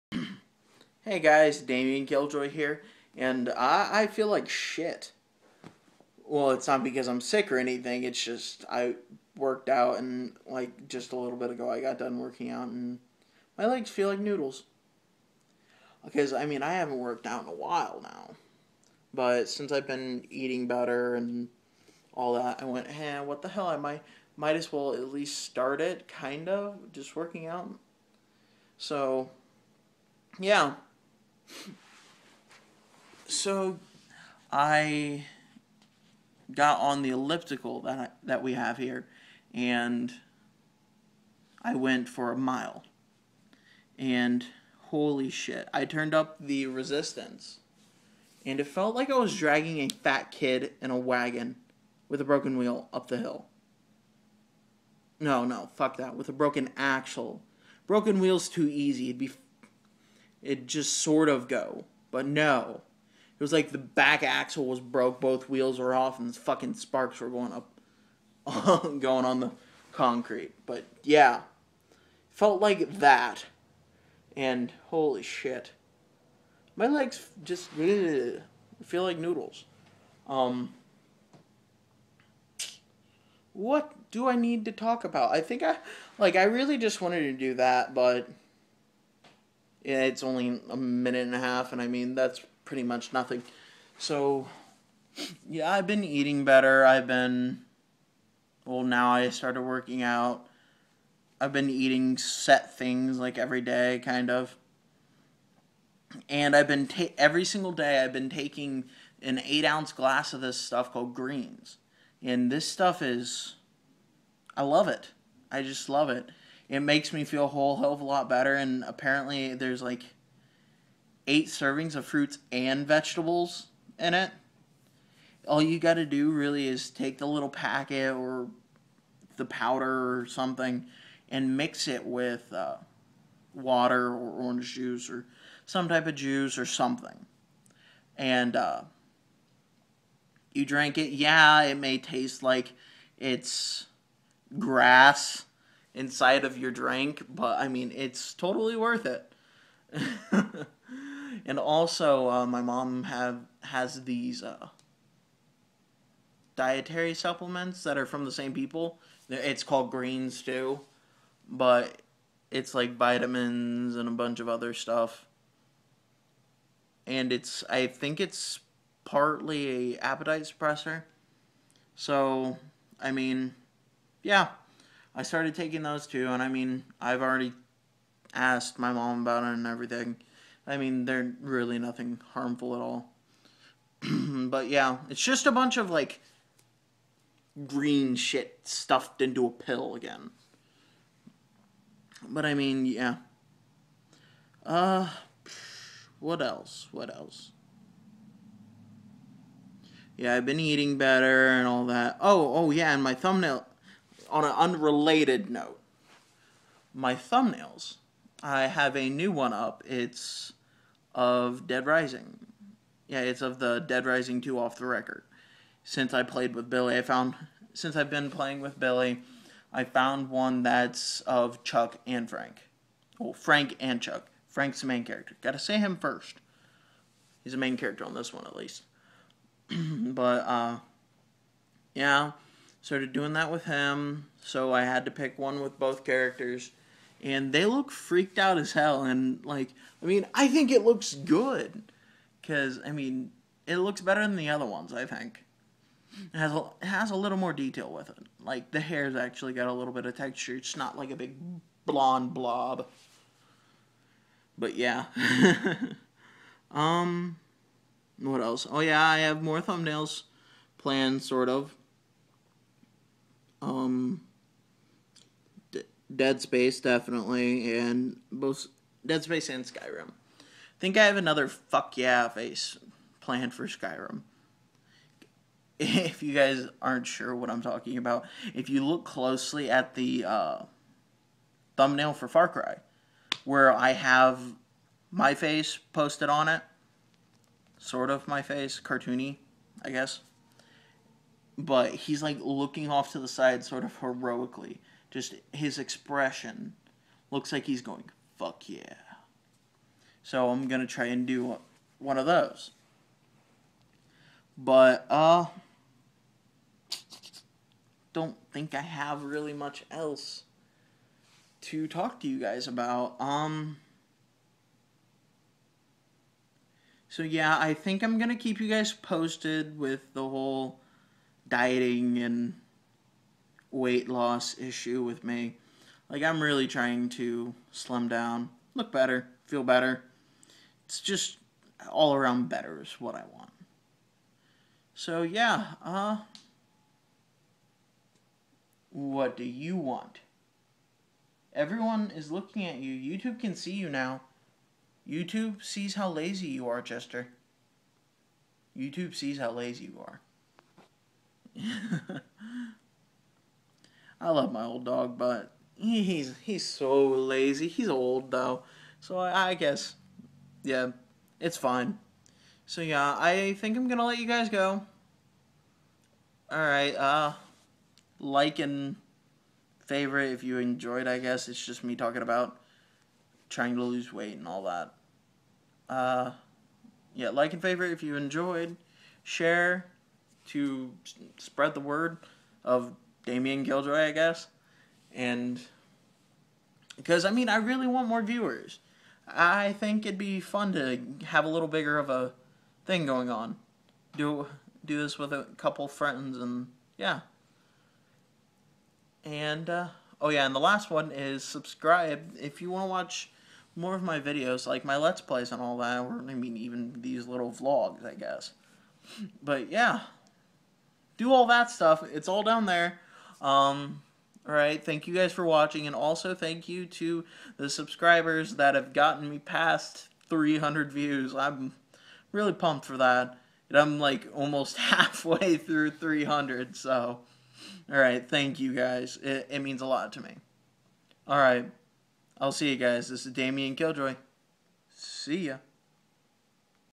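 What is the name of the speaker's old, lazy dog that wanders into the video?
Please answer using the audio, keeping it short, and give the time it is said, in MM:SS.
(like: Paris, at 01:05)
Chester, at 05:46.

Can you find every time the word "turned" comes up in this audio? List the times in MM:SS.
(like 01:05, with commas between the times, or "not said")
00:45.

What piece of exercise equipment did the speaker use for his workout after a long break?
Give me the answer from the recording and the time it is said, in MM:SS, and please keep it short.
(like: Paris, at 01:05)
elliptical, at 00:37.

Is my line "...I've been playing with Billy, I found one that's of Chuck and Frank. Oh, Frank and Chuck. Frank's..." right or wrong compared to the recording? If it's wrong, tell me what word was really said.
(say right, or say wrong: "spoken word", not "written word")
right.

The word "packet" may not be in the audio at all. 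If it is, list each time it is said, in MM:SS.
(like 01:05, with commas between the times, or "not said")
02:07.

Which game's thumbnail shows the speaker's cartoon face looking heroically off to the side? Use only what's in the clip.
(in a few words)
Far Cry.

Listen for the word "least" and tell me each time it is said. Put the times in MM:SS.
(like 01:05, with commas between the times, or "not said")
00:25, 03:48.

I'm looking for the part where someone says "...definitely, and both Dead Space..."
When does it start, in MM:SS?
04:26.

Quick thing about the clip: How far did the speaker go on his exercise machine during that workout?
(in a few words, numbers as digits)
a mile.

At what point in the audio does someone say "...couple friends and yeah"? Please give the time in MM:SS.
06:35.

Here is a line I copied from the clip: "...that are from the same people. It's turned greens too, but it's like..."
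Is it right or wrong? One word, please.
wrong.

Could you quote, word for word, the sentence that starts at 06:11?
I guess it's just me talking about trying to lose weight and all that.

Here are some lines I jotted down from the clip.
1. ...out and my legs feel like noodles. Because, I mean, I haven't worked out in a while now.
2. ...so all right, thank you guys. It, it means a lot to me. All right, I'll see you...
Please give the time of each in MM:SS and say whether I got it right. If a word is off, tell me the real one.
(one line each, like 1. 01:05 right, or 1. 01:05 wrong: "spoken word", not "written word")
1. 00:12 right
2. 07:06 right.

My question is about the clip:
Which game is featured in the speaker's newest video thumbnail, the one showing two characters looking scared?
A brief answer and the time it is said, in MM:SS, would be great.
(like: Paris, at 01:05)
Dead Rising 2, at 03:33.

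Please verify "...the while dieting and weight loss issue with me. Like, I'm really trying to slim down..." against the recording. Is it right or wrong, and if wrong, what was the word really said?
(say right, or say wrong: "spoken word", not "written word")
wrong: "whole", not "while".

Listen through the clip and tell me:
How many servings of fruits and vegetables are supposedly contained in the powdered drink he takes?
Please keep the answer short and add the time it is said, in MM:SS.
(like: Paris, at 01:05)
8, at 02:01.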